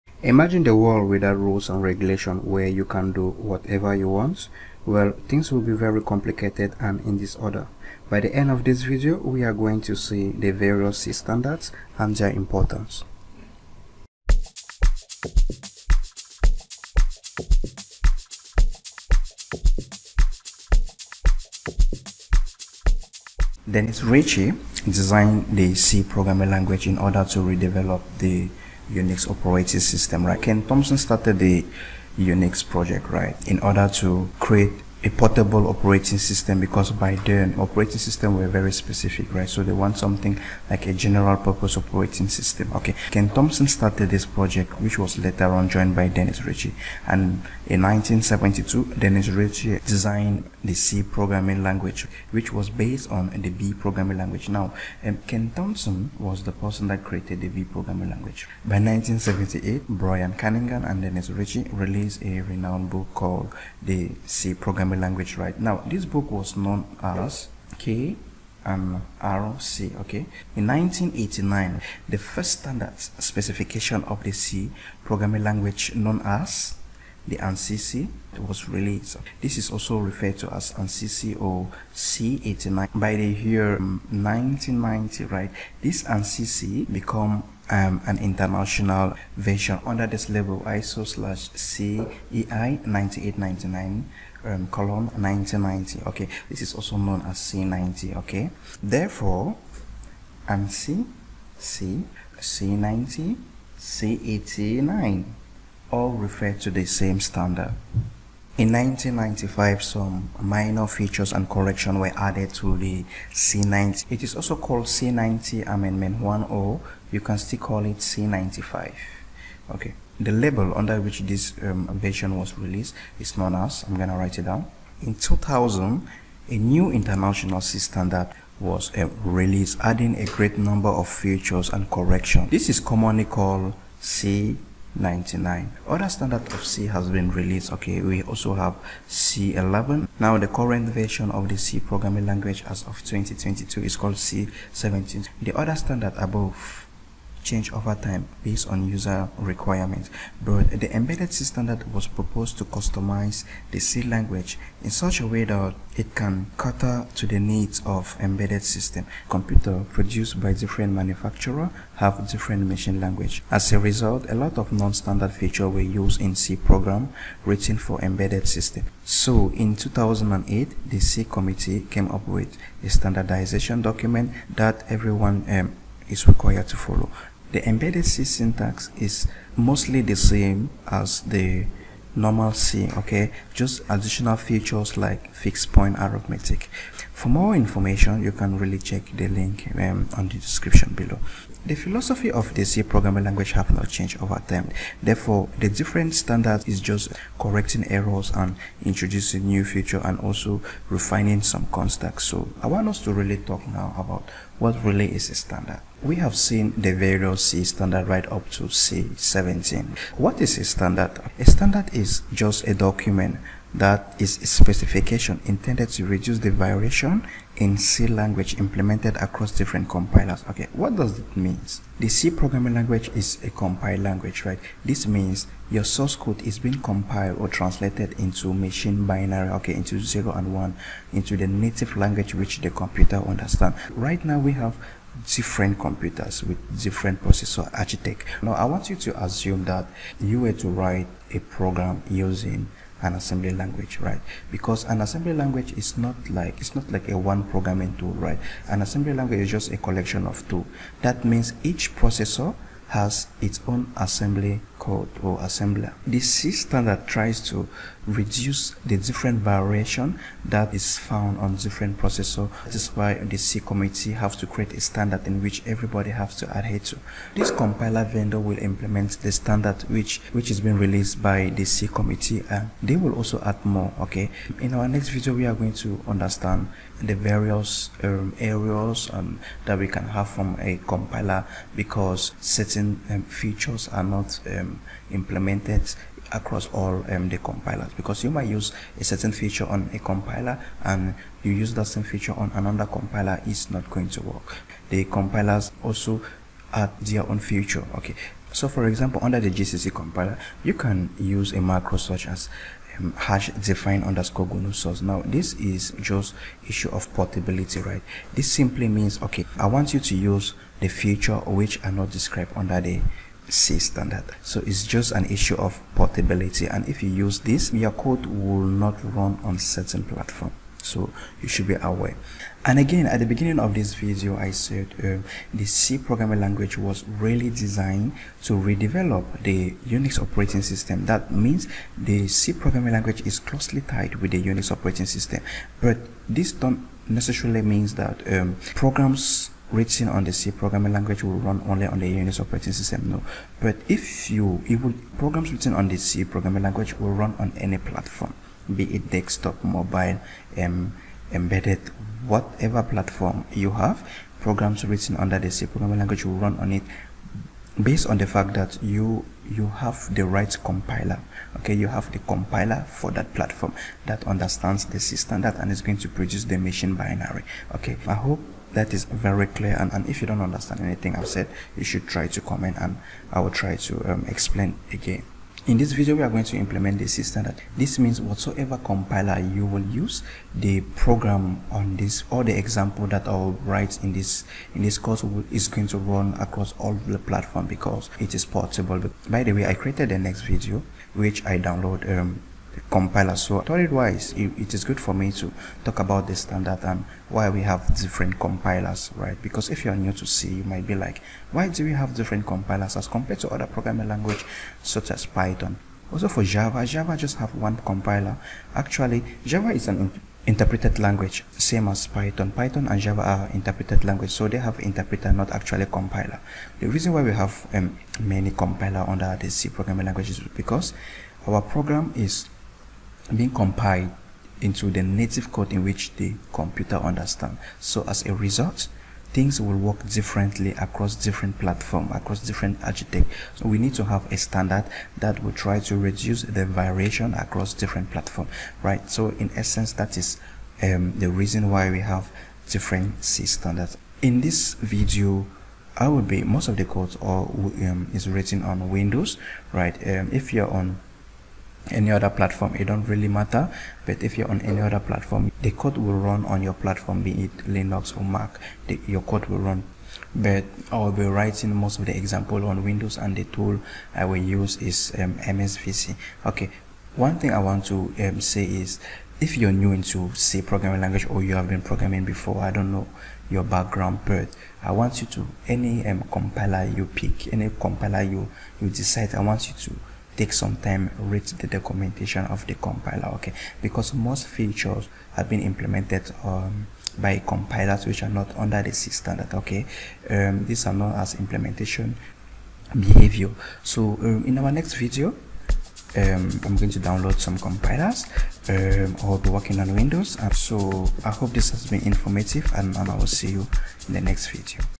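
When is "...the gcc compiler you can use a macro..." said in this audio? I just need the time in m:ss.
4:59.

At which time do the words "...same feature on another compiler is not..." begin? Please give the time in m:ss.
4:51.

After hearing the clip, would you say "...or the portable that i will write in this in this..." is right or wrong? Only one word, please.
wrong.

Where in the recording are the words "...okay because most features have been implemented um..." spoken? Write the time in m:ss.
8:03.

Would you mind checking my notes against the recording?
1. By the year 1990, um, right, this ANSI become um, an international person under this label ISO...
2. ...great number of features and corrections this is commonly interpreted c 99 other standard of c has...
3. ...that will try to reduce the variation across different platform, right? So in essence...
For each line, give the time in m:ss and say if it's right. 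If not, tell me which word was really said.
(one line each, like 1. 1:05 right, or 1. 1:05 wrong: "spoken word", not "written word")
1. 1:22 wrong: "version", not "person"
2. 2:10 wrong: "called", not "interpreted"
3. 7:15 right.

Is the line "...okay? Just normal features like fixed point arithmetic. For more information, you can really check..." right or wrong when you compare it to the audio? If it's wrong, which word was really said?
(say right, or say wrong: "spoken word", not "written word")
wrong: "additional", not "normal".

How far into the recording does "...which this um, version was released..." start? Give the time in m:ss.
2:01.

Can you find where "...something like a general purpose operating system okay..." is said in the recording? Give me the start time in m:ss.
0:39.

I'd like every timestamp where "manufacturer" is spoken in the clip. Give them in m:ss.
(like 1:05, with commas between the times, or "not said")
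2:40.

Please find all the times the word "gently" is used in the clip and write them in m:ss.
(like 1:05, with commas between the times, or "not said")
not said.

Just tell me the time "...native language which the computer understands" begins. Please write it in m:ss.
3:51.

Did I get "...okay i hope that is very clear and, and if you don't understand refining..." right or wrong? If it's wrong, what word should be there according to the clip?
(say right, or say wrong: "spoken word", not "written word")
wrong: "anything", not "refining".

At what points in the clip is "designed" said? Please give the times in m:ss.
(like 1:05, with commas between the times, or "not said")
0:24, 0:49, 5:27.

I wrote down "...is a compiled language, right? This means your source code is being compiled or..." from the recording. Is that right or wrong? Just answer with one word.
right.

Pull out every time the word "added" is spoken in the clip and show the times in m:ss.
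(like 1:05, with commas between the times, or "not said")
1:52.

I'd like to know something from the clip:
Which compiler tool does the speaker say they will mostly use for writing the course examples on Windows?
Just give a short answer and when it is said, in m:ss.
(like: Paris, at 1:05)
MSVC, at 7:45.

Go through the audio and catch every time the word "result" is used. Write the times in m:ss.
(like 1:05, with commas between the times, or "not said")
2:43, 7:08.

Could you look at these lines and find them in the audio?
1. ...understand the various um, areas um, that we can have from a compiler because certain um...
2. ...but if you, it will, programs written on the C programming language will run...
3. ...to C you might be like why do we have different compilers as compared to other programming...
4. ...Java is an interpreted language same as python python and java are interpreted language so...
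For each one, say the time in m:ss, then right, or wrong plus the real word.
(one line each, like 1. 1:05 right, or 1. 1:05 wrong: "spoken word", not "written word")
1. 4:36 right
2. 5:43 right
3. 6:40 right
4. 6:49 right.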